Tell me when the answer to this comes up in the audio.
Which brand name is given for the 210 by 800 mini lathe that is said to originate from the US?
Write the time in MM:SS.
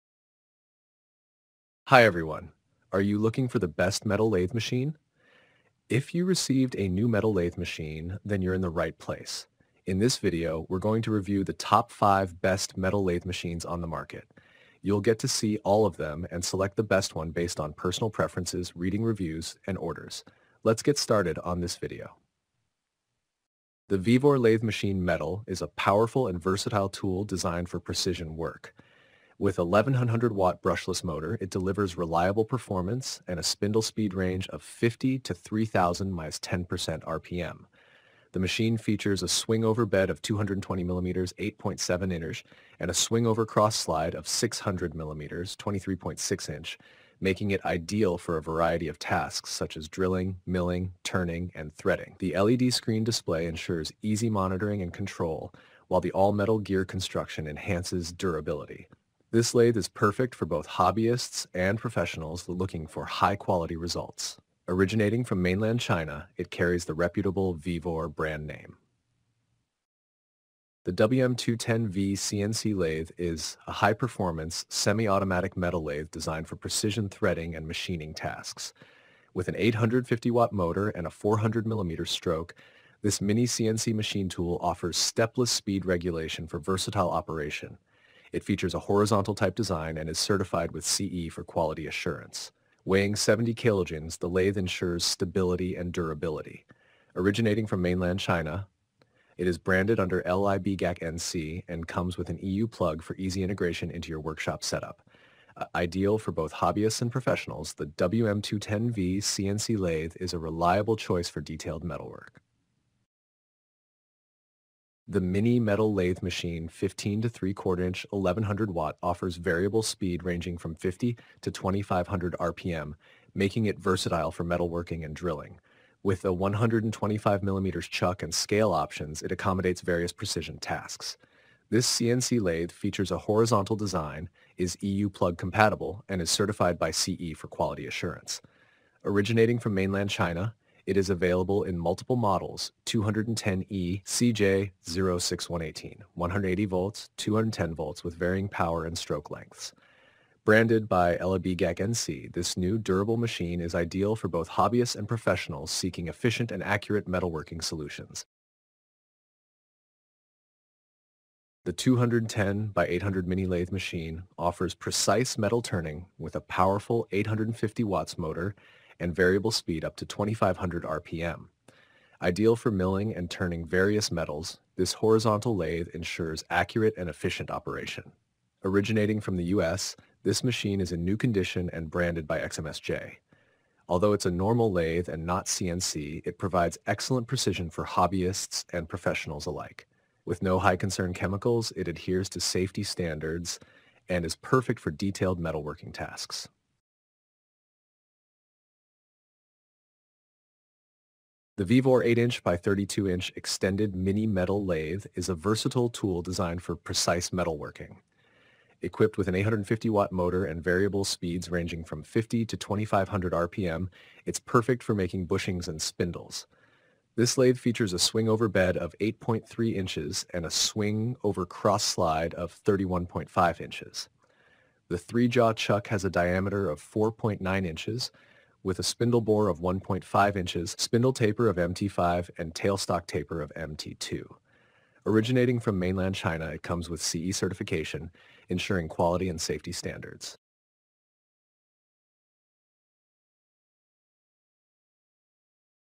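03:02.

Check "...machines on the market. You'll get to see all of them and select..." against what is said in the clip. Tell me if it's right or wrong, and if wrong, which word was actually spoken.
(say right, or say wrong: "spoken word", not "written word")
right.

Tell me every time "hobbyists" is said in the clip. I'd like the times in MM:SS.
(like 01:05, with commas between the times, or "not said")
01:00, 01:46, 02:34, 03:07.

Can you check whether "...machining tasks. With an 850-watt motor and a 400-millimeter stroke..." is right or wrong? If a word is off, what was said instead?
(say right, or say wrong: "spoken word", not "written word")
right.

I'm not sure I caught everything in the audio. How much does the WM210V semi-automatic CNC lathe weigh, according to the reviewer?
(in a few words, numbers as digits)
70 kilograms.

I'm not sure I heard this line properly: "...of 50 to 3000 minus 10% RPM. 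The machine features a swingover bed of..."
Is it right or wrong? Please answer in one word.
right.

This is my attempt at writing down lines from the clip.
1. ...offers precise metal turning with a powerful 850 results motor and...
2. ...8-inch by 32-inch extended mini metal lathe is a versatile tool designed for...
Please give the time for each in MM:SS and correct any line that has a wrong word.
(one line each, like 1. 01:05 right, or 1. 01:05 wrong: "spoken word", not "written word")
1. 02:44 wrong: "watts", not "results"
2. 03:22 right.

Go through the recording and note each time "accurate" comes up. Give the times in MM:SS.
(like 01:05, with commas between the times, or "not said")
02:36, 02:56.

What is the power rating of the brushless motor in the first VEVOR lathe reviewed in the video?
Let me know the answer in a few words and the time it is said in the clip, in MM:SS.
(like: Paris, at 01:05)
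1100 watts, at 00:29.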